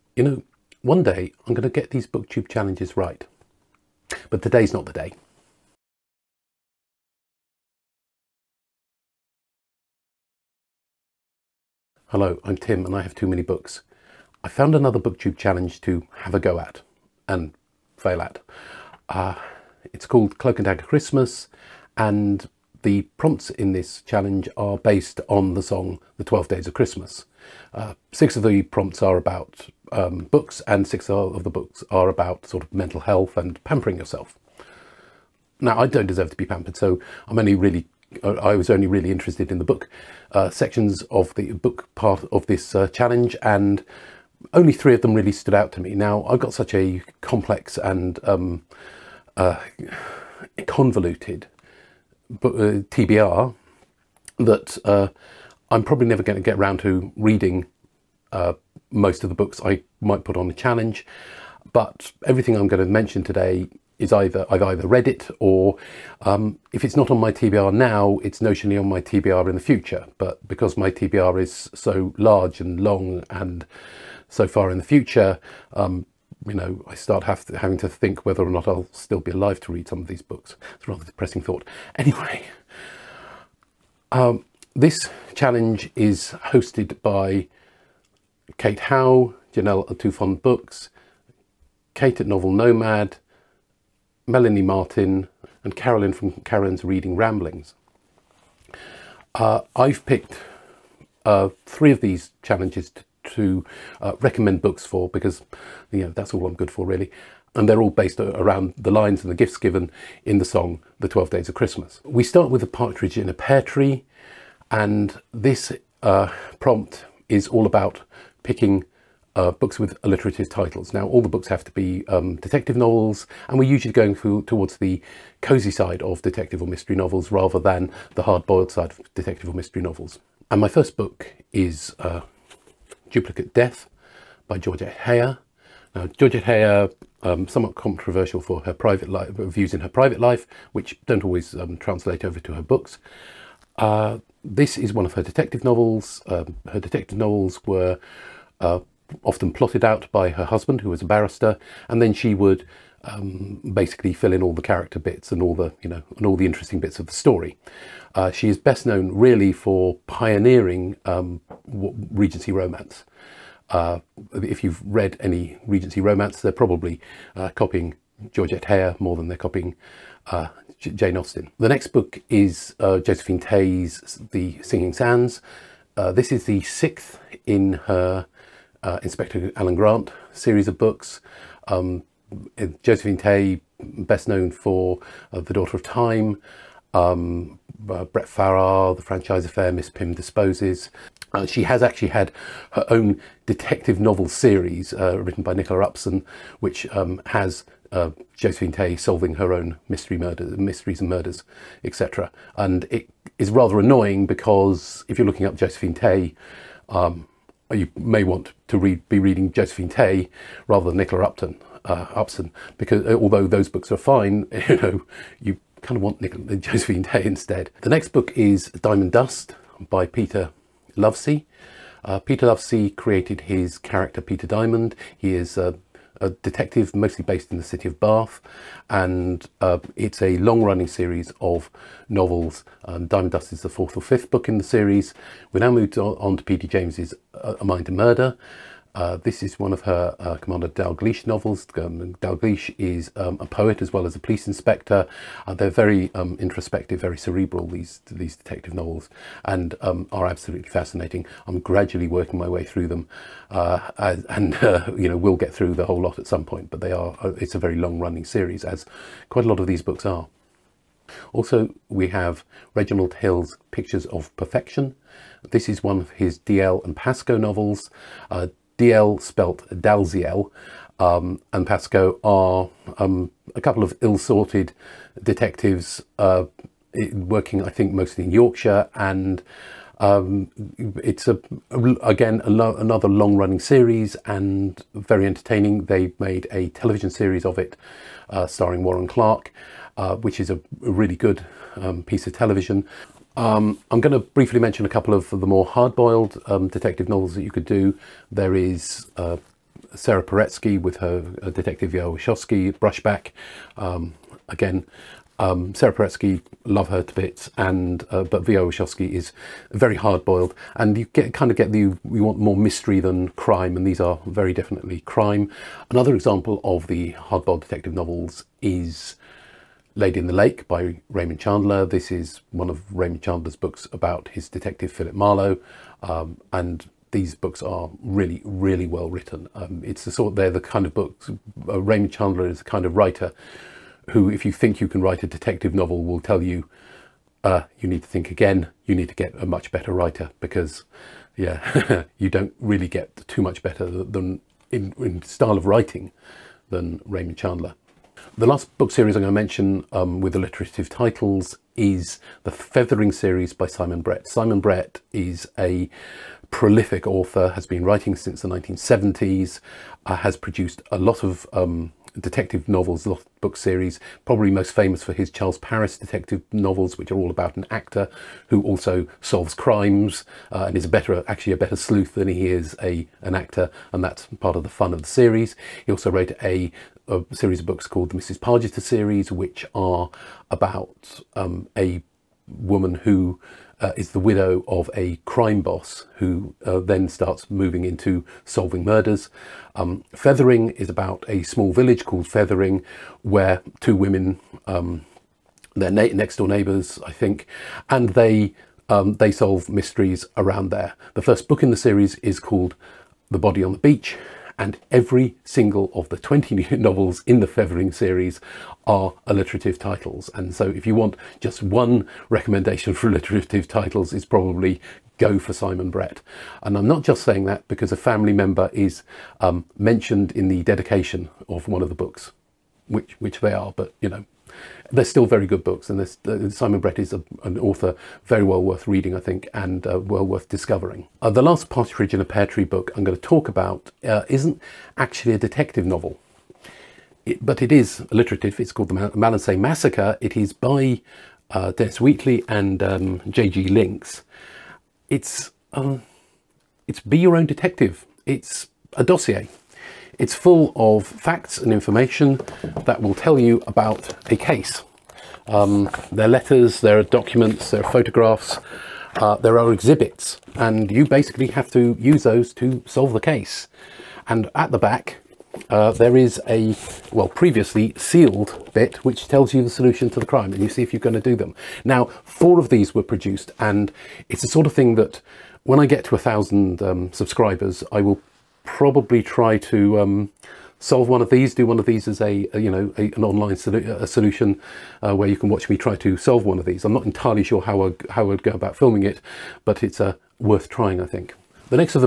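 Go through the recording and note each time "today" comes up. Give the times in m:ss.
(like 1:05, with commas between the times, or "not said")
0:04, 1:03.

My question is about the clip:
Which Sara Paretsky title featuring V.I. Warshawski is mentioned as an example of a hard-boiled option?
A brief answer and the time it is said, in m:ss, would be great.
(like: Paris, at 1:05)
Brushback, at 5:02.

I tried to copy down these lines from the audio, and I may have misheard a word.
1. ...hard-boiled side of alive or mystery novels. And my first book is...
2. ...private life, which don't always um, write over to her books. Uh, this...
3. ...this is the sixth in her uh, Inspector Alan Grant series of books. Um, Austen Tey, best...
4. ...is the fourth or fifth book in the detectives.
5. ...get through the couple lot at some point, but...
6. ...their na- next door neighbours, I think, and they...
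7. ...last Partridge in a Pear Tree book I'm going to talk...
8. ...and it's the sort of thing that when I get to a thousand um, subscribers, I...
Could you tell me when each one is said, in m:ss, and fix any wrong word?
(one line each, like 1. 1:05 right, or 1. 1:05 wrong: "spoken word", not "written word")
1. 2:08 wrong: "detective", not "alive"
2. 2:19 wrong: "translate", not "write"
3. 2:56 wrong: "Josephine", not "Austen"
4. 3:53 wrong: "series", not "detectives"
5. 4:15 wrong: "whole", not "couple"
6. 6:35 right
7. 7:11 right
8. 7:53 right.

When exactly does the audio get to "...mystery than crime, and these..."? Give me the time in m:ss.
5:12.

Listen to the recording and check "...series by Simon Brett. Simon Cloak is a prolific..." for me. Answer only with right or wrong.
wrong.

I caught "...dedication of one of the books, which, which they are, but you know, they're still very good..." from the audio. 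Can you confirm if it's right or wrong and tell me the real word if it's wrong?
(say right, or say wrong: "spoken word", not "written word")
right.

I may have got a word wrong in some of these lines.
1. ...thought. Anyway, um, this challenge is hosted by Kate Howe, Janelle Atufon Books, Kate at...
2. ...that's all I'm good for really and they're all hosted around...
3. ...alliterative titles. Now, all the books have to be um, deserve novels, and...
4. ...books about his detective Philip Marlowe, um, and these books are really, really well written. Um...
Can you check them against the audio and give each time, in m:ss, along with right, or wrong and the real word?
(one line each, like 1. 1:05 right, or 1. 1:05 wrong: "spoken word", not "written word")
1. 1:21 right
2. 1:46 wrong: "based", not "hosted"
3. 2:00 wrong: "detective", not "deserve"
4. 5:23 right.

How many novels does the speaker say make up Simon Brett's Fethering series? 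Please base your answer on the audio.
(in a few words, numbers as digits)
20.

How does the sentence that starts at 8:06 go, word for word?
I'm not entirely sure how I, how I'd go about filming it, but it's uh, worth trying, I think.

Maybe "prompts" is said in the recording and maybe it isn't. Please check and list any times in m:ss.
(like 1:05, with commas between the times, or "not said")
0:23, 0:28, 1:56.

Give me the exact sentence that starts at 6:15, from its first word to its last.
He also wrote a, a series of books called the Mrs.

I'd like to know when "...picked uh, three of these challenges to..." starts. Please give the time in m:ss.
1:40.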